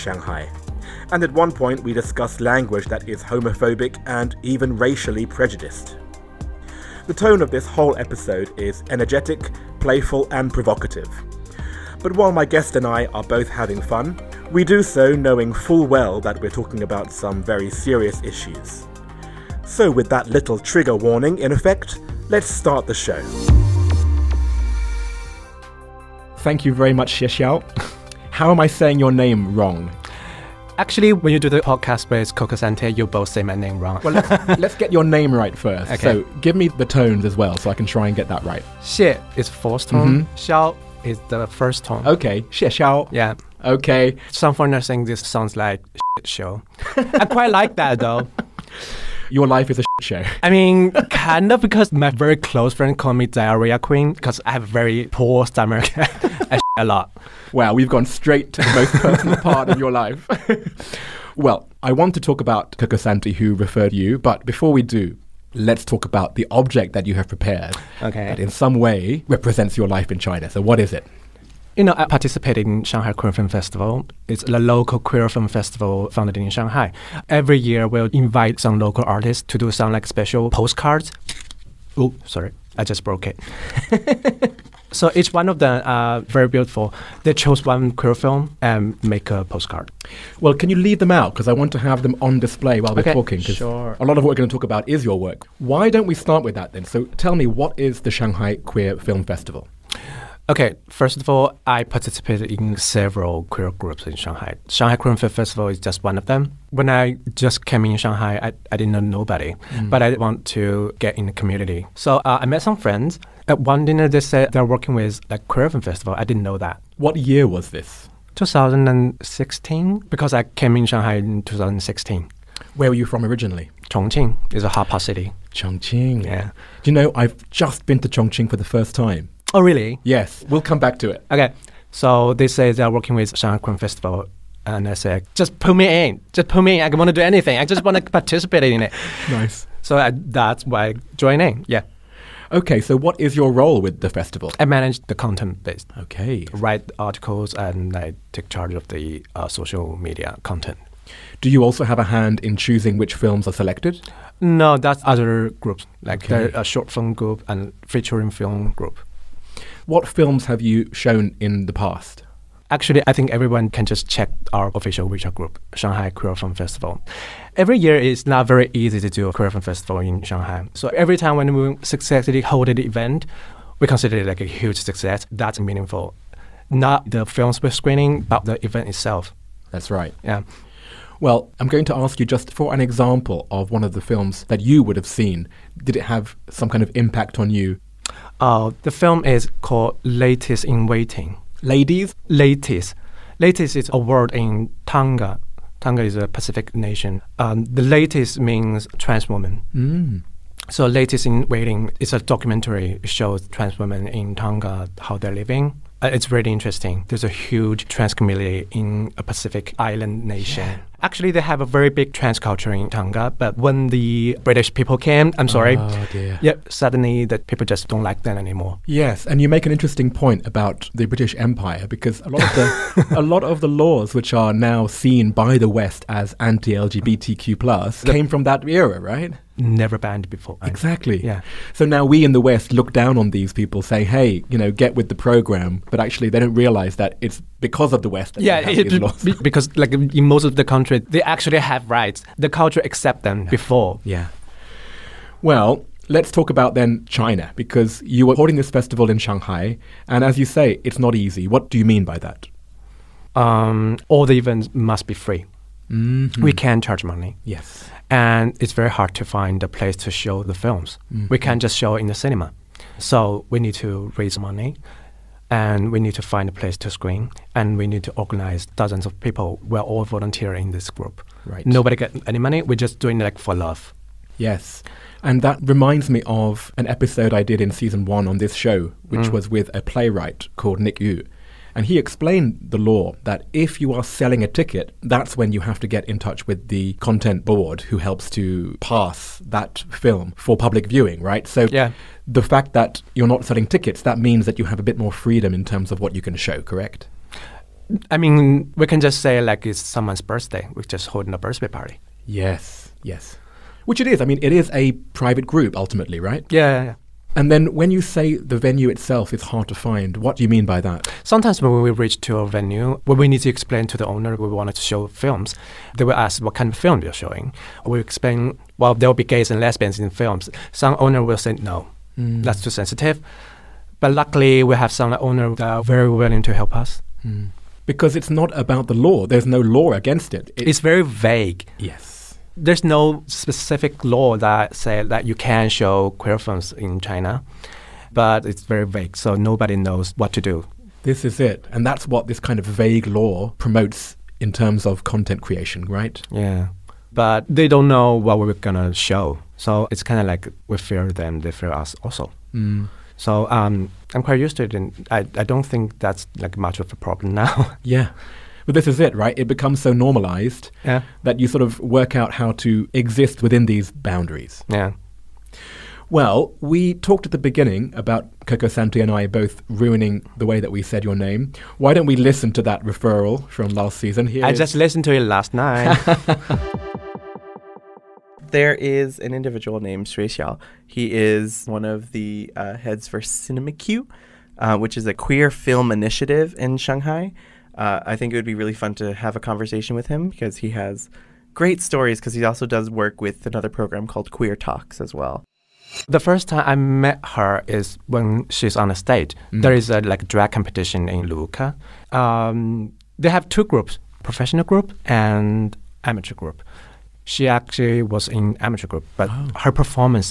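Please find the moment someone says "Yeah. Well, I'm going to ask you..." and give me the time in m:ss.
3:00.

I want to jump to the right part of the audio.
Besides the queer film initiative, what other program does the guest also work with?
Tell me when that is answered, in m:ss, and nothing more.
6:34.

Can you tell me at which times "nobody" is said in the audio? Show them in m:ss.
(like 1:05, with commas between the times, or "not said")
1:48, 4:31, 5:39.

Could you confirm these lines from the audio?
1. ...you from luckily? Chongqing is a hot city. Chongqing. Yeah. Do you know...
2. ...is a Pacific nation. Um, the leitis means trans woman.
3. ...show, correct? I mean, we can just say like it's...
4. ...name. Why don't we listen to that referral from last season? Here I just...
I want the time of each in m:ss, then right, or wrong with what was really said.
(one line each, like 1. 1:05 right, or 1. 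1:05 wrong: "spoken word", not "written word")
1. 2:02 wrong: "originally", not "luckily"
2. 3:16 right
3. 4:56 right
4. 6:11 right.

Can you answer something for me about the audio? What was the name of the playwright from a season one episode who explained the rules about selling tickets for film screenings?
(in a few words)
Nick Yu.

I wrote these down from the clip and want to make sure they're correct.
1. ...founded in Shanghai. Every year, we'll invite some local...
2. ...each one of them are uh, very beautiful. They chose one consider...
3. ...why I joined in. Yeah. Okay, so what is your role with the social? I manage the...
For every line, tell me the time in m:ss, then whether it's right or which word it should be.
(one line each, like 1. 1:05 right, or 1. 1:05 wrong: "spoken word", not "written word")
1. 1:16 right
2. 1:25 wrong: "queer", not "consider"
3. 2:20 wrong: "festival", not "social".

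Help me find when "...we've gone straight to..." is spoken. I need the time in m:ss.
0:57.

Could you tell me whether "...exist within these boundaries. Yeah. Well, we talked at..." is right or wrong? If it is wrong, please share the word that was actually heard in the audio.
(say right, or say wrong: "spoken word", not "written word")
right.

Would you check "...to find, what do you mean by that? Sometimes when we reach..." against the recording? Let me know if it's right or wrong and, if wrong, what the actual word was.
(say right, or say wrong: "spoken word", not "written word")
right.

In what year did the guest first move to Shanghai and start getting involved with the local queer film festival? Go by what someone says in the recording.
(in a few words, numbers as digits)
2016.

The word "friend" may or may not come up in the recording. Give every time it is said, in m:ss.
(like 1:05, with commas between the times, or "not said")
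0:52, 1:52.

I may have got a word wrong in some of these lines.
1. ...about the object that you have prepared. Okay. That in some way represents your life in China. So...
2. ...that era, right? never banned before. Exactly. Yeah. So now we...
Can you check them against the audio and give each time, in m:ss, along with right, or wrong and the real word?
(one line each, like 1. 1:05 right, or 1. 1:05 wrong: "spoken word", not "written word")
1. 1:06 right
2. 3:48 right.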